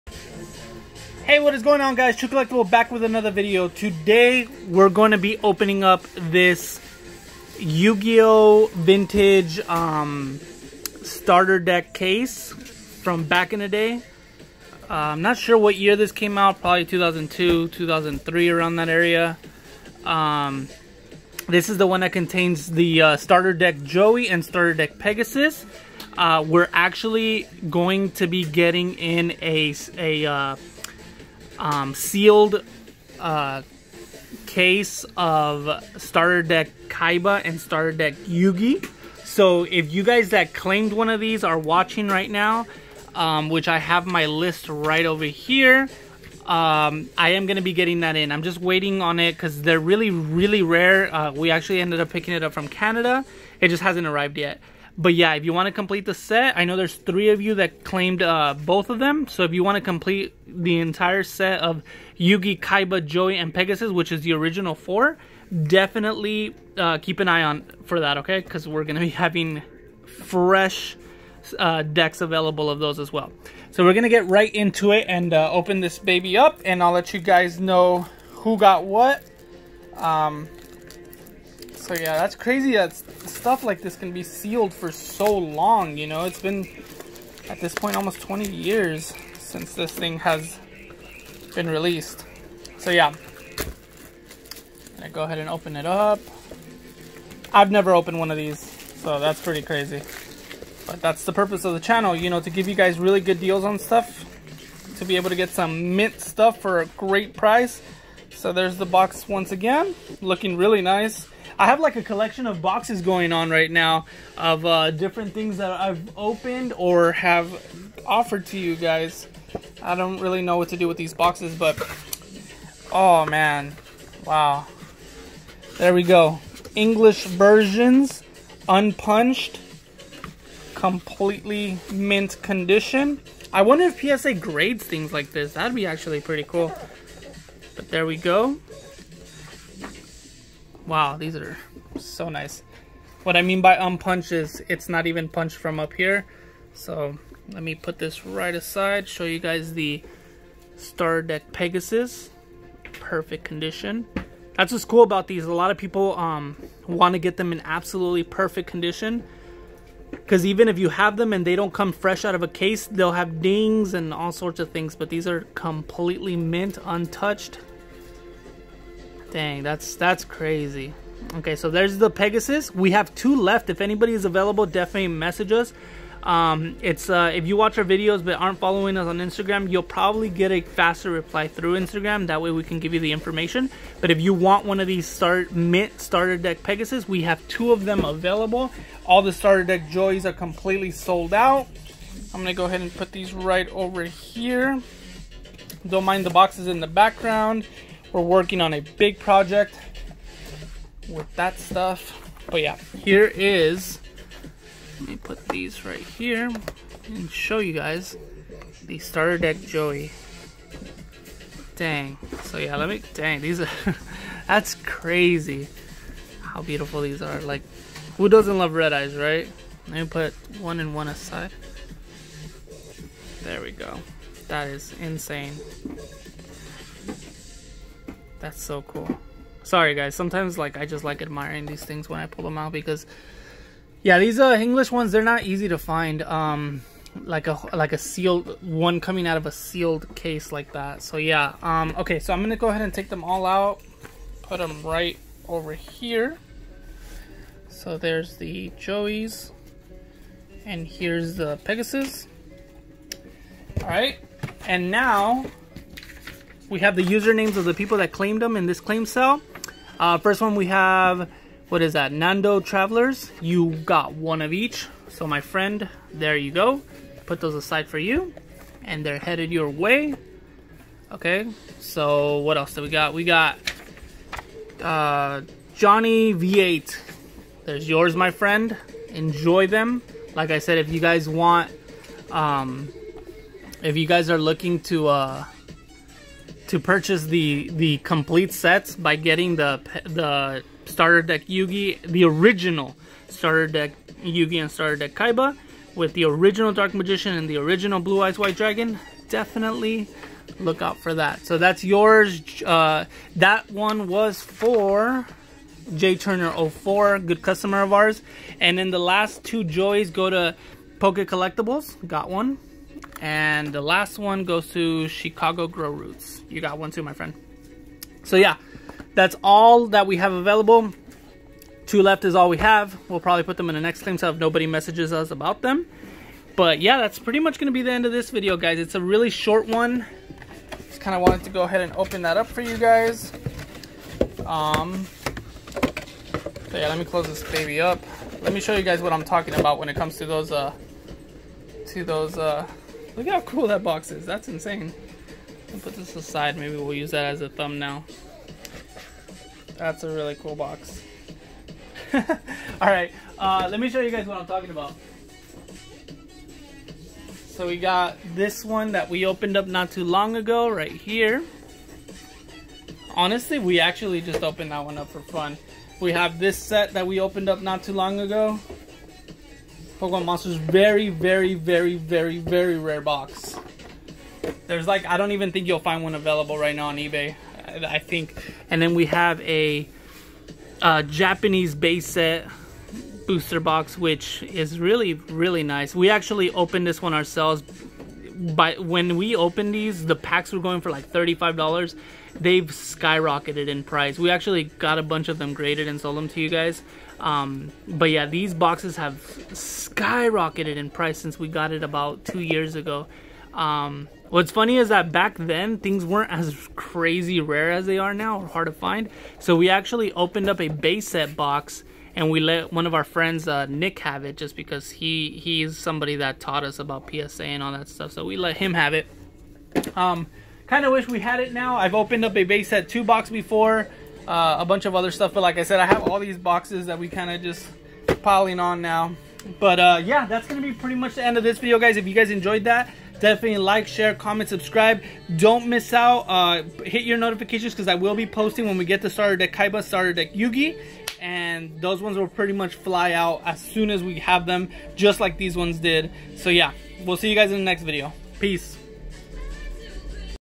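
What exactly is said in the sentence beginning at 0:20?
Um, this is the one that contains the uh, Starter Deck Joey and Starter Deck Pegasus.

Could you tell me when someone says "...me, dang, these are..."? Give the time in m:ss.
3:32.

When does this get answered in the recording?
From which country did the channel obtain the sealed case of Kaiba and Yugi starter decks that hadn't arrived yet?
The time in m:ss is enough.
0:52.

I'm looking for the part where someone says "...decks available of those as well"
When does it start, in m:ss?
1:11.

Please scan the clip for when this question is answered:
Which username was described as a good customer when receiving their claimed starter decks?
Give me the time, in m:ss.
5:05.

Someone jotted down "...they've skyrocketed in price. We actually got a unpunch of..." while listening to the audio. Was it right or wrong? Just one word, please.
wrong.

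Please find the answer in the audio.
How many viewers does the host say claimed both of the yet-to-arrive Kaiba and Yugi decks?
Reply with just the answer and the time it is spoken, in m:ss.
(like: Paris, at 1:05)
3, at 0:56.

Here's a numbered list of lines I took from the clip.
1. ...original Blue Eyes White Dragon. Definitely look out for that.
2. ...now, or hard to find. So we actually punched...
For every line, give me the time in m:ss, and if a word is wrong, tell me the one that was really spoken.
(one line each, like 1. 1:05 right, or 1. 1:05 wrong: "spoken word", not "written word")
1. 4:57 right
2. 6:48 wrong: "opened", not "punched".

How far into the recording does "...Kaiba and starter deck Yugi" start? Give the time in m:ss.
0:36.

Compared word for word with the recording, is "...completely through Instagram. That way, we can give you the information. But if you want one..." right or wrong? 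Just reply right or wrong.
wrong.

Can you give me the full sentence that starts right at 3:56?
Um, like a like a sealed one coming out of a sealed case like that.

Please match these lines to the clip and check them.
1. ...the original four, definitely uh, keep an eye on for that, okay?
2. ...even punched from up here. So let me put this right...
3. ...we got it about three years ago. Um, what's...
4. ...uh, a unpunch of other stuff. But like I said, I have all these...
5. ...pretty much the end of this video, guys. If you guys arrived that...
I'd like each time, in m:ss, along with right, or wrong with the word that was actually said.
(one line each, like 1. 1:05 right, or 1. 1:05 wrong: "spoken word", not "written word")
1. 1:04 right
2. 2:25 right
3. 6:41 wrong: "two", not "three"
4. 7:04 wrong: "bunch", not "unpunch"
5. 7:10 wrong: "enjoyed", not "arrived".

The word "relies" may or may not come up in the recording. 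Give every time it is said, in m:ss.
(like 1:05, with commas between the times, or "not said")
not said.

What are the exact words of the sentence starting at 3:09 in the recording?
All the starter deck Joeys are completely sold out.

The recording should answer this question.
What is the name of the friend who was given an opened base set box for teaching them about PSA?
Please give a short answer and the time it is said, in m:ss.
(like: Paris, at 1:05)
Nick, at 6:53.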